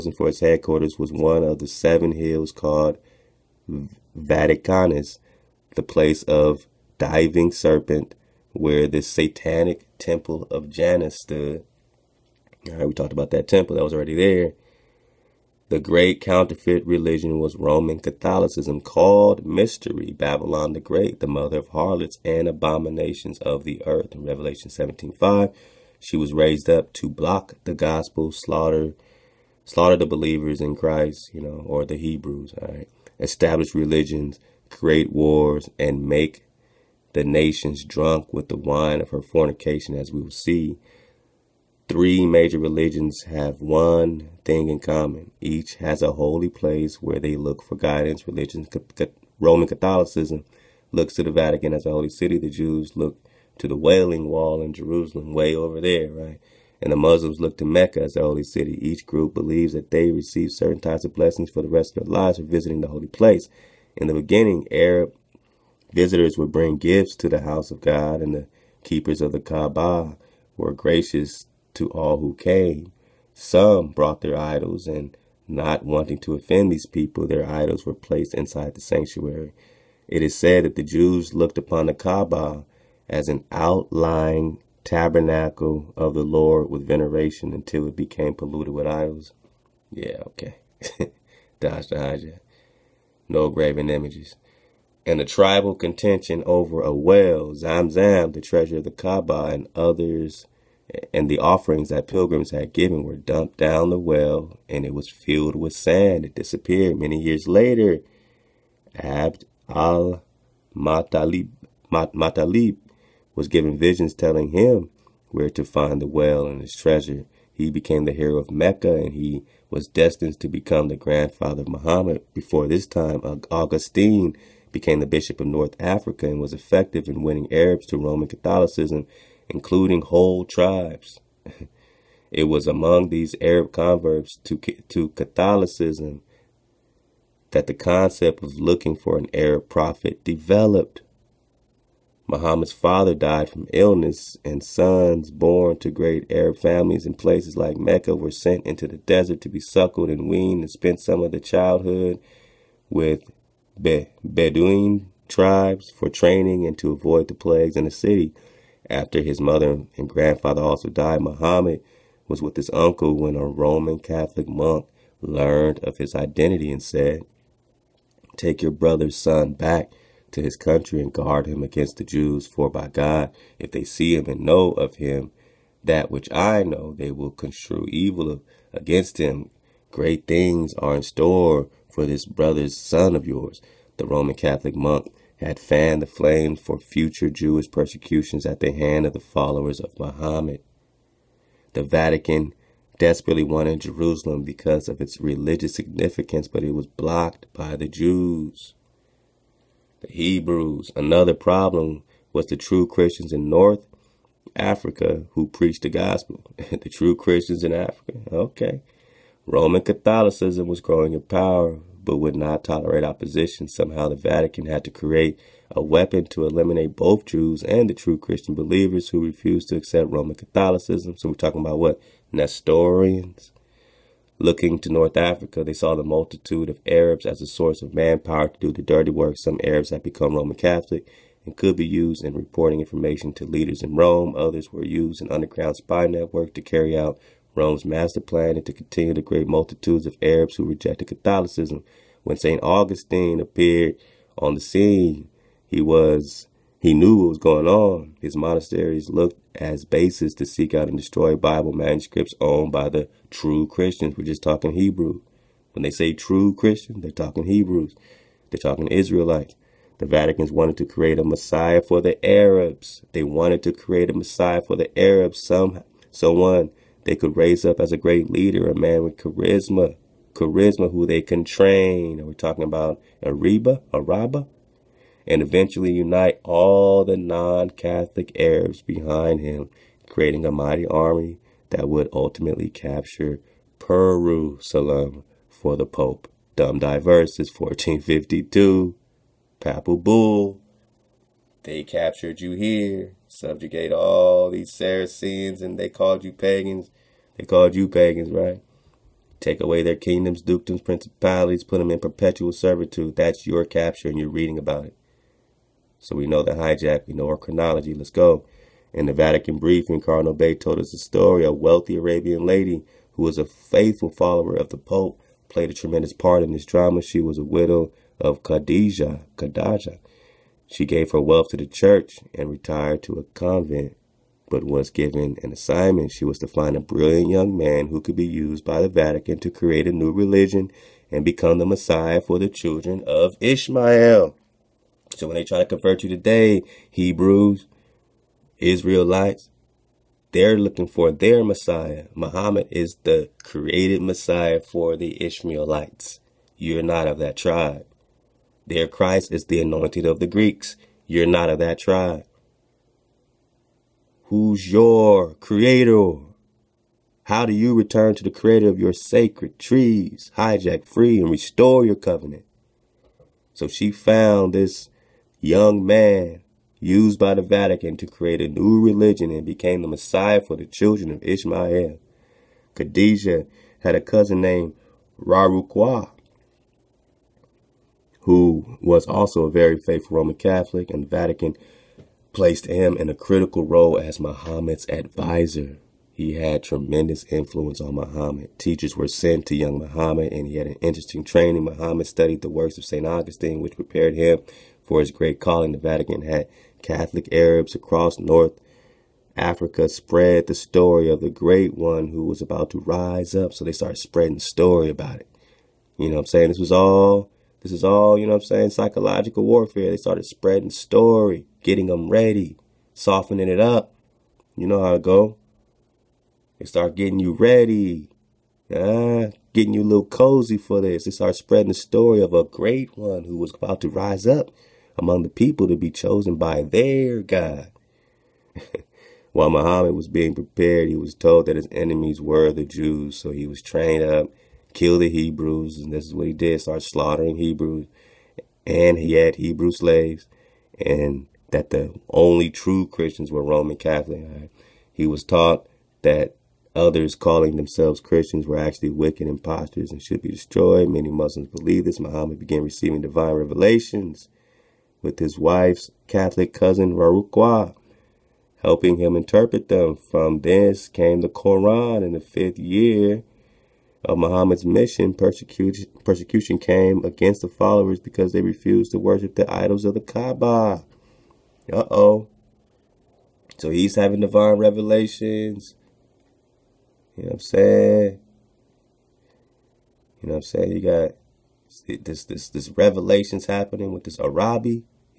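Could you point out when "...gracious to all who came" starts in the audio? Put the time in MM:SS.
01:10.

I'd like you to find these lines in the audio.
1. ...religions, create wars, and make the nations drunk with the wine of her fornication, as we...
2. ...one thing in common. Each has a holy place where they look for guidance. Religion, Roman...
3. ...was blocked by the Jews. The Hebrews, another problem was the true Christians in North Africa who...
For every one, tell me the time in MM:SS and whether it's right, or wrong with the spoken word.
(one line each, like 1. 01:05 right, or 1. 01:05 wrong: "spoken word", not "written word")
1. 00:33 right
2. 00:43 right
3. 03:16 right.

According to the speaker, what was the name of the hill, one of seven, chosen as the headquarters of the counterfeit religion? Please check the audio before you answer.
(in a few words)
Vaticanus.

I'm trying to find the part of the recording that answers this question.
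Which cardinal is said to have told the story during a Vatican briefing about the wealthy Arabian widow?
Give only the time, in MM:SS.
05:10.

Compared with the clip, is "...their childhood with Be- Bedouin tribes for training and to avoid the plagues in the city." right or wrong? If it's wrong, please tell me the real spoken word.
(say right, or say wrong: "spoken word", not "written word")
right.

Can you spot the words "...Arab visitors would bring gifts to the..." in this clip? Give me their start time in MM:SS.
01:04.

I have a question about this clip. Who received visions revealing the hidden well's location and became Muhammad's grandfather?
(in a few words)
Abd al Matalib.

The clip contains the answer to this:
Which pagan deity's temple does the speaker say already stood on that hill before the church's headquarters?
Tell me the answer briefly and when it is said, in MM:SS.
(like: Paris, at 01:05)
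Janus, at 00:10.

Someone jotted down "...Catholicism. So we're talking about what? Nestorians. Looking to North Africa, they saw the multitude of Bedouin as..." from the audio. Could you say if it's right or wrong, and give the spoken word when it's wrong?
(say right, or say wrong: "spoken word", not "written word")
wrong: "Arabs", not "Bedouin".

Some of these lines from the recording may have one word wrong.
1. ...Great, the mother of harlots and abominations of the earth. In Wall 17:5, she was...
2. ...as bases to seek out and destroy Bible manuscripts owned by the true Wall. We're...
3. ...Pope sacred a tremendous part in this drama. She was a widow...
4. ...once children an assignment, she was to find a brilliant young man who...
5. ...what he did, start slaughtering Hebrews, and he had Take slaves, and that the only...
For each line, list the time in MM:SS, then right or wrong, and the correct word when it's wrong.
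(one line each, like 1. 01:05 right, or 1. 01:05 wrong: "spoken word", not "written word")
1. 00:20 wrong: "Revelation", not "Wall"
2. 04:09 wrong: "Christians", not "Wall"
3. 05:14 wrong: "played", not "sacred"
4. 05:24 wrong: "given", not "children"
5. 07:16 wrong: "Hebrew", not "Take".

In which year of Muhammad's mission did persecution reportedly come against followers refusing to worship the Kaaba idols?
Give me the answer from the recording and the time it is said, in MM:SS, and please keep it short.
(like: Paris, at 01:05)
Fifth year, at 07:42.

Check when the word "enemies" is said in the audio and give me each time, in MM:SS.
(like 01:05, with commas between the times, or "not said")
07:11.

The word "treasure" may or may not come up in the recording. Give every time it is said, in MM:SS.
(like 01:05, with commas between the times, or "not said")
01:38, 01:56.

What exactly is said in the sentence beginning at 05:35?
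So when they try to convert you today, Hebrews, Israelites, they're looking for their Messiah.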